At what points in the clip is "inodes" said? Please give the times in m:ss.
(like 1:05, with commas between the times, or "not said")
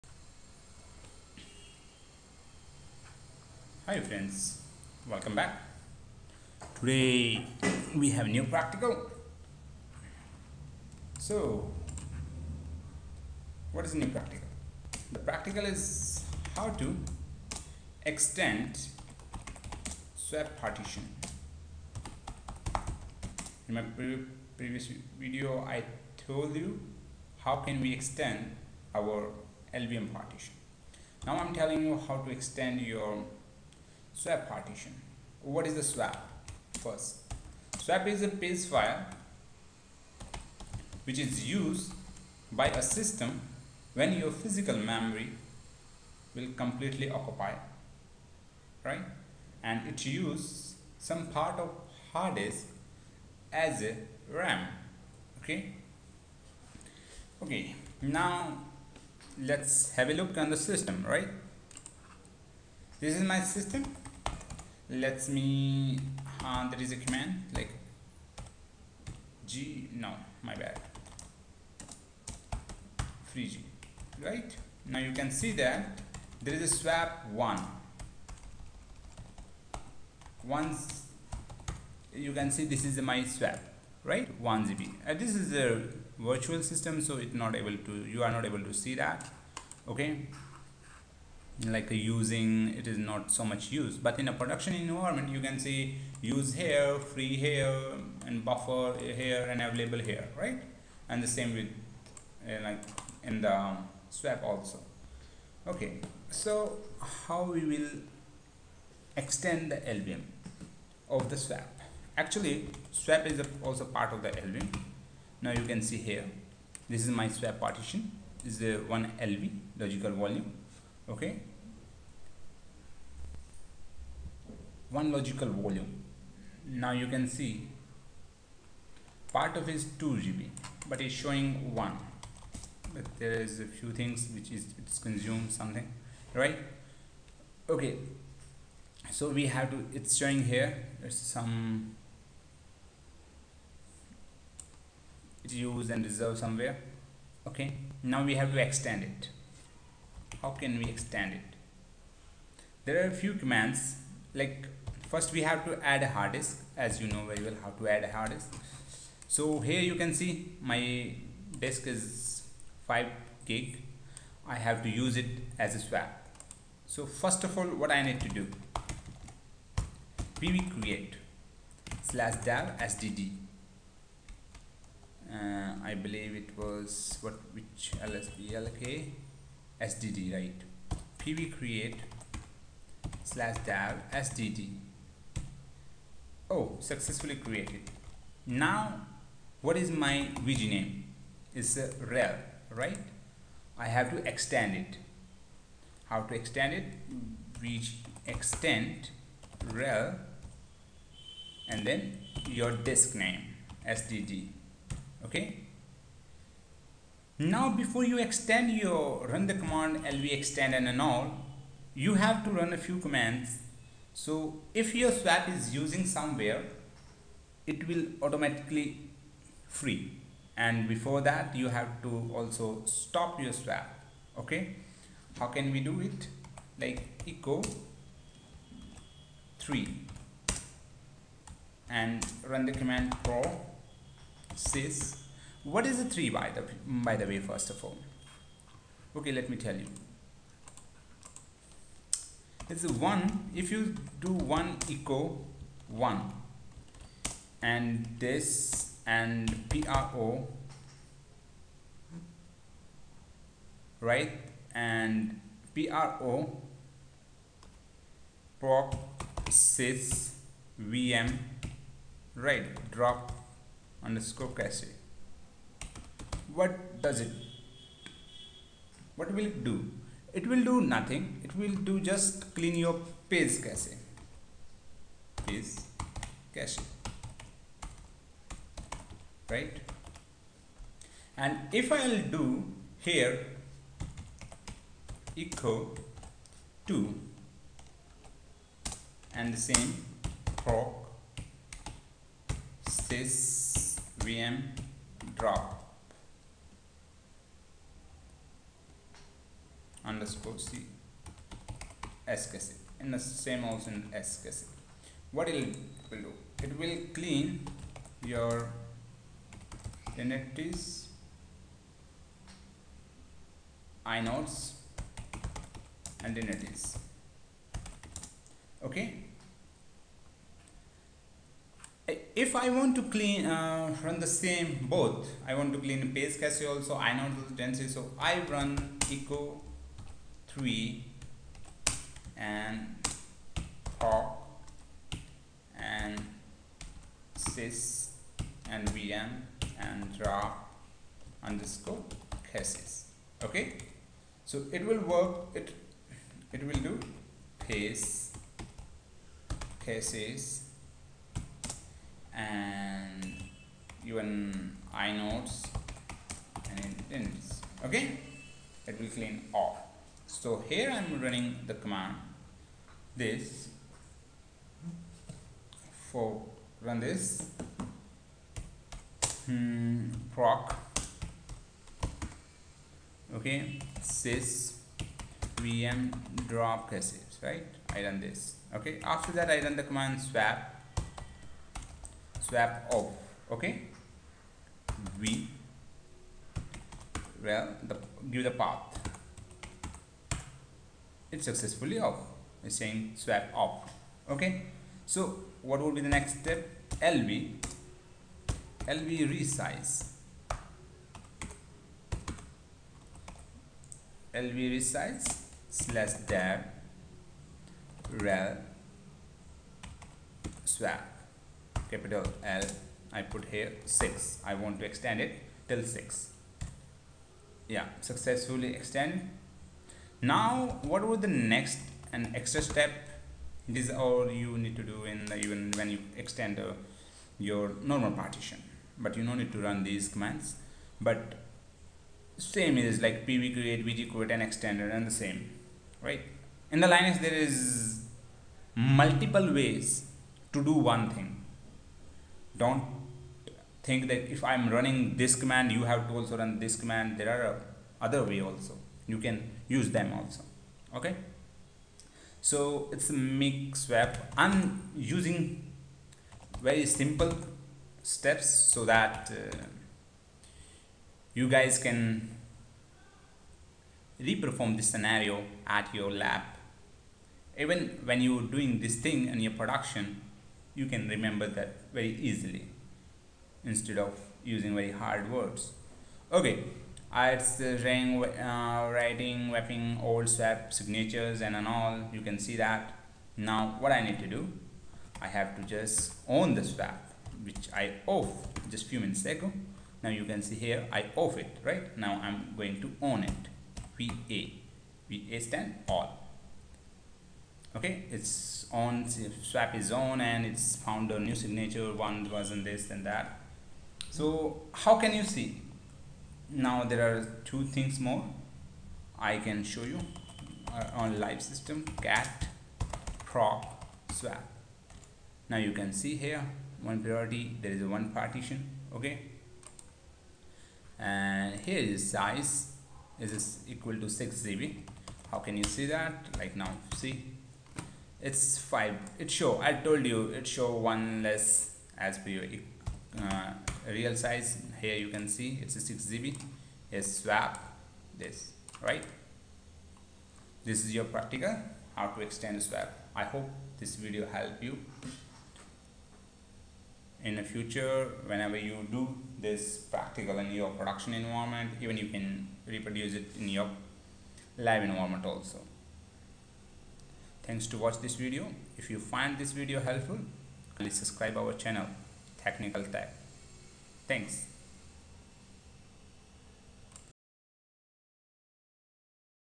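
5:14, 5:55.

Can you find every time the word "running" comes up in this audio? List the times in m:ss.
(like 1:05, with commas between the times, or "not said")
6:01, 7:24.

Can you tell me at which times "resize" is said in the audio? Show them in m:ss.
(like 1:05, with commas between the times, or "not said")
6:39, 6:44.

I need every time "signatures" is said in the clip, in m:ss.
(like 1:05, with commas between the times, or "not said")
8:00, 8:21.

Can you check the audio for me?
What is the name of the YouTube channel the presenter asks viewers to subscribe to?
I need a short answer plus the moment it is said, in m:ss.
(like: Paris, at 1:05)
Technical Tech, at 9:22.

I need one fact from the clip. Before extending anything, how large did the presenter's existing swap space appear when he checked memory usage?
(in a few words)
1 GB.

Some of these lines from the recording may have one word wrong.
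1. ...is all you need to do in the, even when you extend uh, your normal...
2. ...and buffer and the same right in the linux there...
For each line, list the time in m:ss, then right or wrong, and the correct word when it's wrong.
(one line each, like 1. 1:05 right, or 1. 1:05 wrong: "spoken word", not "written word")
1. 7:03 right
2. 7:14 wrong: "extender", not "buffer".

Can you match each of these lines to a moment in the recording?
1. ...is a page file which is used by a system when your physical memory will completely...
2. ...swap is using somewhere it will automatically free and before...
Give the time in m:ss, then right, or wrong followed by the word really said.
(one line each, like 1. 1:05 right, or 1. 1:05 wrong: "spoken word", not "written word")
1. 0:38 right
2. 3:35 right.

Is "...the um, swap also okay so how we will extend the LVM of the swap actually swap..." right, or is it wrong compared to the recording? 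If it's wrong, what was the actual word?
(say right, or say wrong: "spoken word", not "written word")
right.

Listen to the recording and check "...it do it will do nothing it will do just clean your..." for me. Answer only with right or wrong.
right.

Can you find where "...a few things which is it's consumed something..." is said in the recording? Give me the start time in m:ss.
2:13.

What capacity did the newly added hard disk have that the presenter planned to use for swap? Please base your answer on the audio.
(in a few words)
5 gig.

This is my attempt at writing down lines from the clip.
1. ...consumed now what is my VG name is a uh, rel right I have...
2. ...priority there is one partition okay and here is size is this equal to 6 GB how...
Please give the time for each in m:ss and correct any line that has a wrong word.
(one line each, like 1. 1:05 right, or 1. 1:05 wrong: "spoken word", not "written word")
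1. 3:07 wrong: "created", not "consumed"
2. 8:37 right.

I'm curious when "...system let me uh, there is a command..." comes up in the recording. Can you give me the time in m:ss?
1:03.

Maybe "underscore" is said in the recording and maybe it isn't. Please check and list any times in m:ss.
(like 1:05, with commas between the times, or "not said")
4:24, 5:00, 5:41.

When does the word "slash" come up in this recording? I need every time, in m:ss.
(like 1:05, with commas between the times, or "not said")
2:52, 3:03, 6:45.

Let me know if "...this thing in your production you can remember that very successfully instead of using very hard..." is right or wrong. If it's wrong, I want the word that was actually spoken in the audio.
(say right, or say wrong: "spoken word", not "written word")
wrong: "easily", not "successfully".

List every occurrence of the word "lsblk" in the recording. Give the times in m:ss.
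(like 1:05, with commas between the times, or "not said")
2:58.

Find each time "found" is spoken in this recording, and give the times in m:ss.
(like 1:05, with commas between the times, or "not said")
8:20.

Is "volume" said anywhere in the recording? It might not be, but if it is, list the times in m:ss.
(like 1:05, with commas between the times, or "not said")
2:00, 2:05.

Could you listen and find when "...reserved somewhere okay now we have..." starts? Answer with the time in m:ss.
2:26.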